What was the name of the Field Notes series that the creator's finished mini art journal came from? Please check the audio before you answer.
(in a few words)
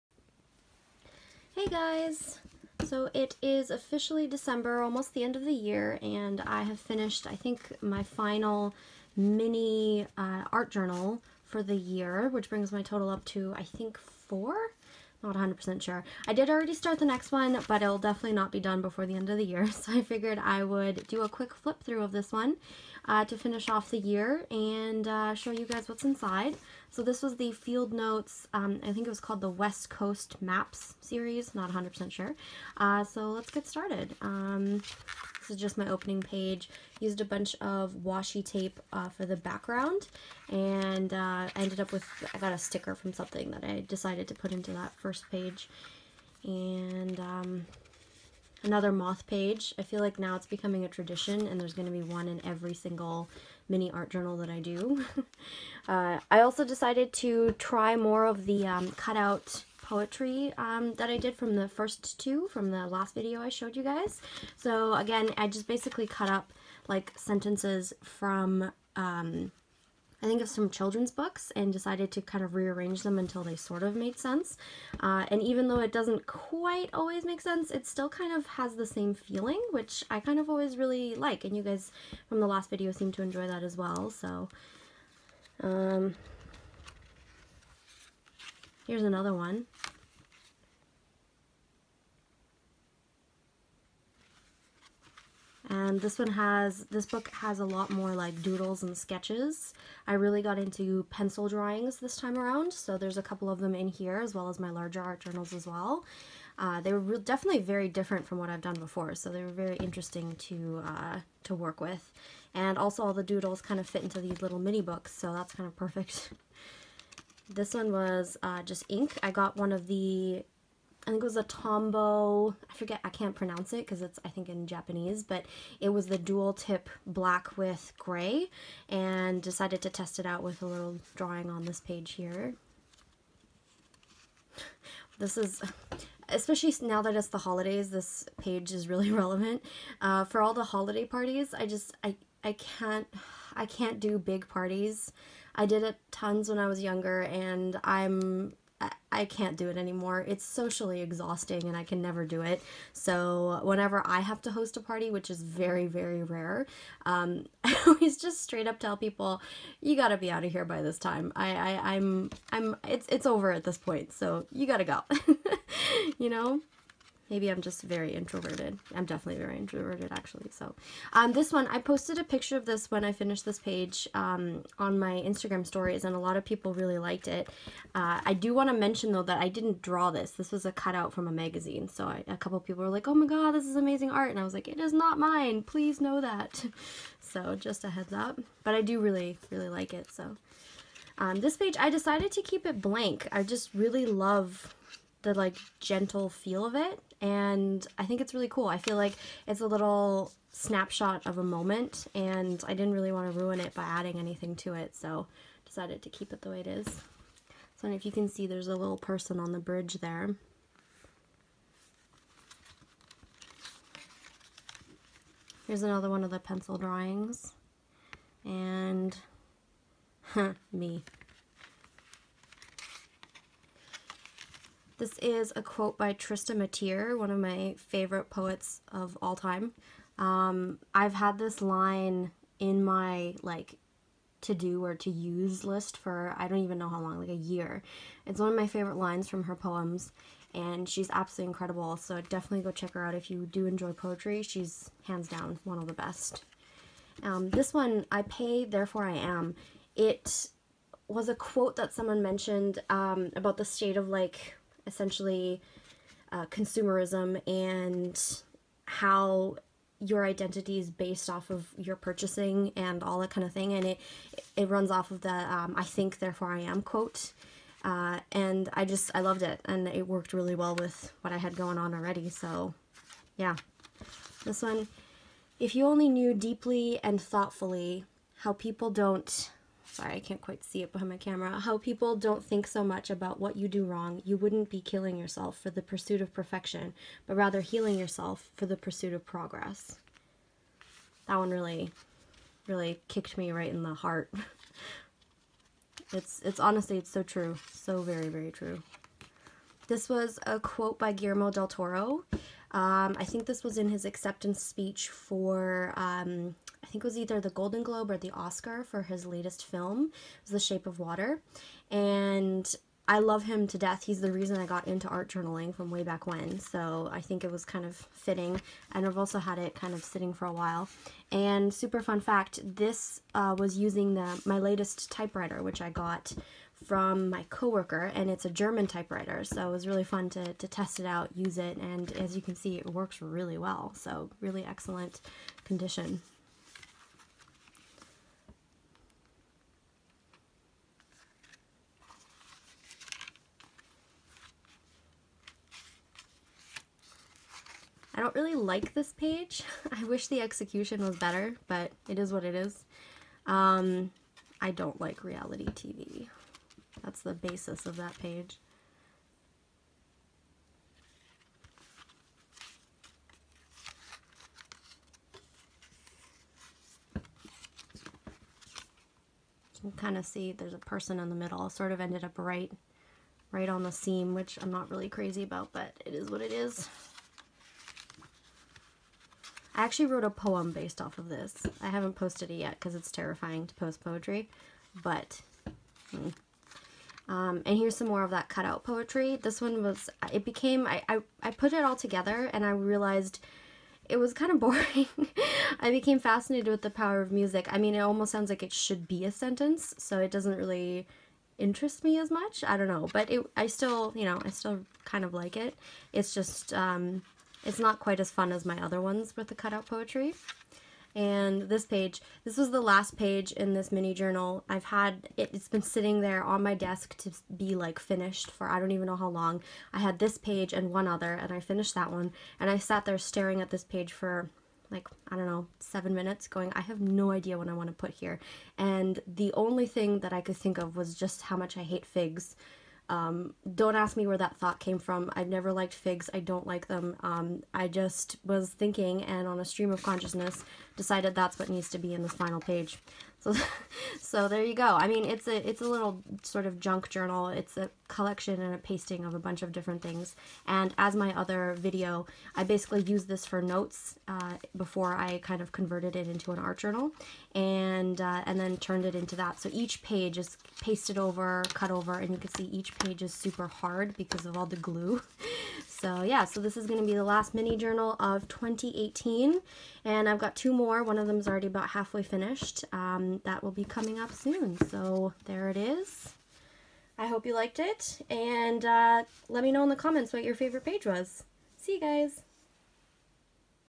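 West Coast Maps.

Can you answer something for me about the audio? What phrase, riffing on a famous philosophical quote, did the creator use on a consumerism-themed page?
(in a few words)
I pay, therefore I am.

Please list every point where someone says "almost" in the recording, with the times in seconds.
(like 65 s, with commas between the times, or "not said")
4 s, 397 s.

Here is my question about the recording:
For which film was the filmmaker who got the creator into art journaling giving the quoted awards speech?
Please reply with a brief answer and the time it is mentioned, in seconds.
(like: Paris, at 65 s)
The Shape of Water, at 310 s.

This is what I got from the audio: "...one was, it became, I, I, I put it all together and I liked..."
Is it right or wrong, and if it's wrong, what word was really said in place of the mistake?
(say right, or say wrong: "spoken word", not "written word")
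wrong: "realized", not "liked".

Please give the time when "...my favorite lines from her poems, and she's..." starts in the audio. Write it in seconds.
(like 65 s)
238 s.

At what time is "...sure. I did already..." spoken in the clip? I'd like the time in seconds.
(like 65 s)
15 s.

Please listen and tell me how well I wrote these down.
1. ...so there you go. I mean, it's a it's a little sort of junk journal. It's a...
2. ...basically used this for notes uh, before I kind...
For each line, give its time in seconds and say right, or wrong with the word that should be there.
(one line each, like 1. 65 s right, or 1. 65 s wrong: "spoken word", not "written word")
1. 444 s right
2. 452 s right.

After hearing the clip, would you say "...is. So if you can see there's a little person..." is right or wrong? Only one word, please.
right.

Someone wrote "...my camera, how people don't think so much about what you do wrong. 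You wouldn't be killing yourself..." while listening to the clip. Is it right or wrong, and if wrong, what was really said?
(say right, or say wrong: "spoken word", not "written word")
right.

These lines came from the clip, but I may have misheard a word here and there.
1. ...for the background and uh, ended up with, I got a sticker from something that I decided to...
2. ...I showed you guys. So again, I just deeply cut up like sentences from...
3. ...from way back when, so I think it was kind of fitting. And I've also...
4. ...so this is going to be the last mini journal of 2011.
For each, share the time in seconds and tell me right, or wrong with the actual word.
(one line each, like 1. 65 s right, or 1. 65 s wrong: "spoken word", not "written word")
1. 39 s right
2. 63 s wrong: "basically", not "deeply"
3. 315 s right
4. 466 s wrong: "2018", not "2011".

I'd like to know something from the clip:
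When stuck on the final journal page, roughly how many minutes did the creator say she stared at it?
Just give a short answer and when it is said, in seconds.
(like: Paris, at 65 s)
7, at 425 s.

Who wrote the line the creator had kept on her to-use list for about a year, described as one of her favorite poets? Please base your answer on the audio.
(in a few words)
Trista Mateer.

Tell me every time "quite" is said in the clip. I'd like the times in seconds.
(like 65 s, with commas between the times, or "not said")
76 s, 280 s, 408 s.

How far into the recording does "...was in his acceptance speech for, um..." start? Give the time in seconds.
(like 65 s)
303 s.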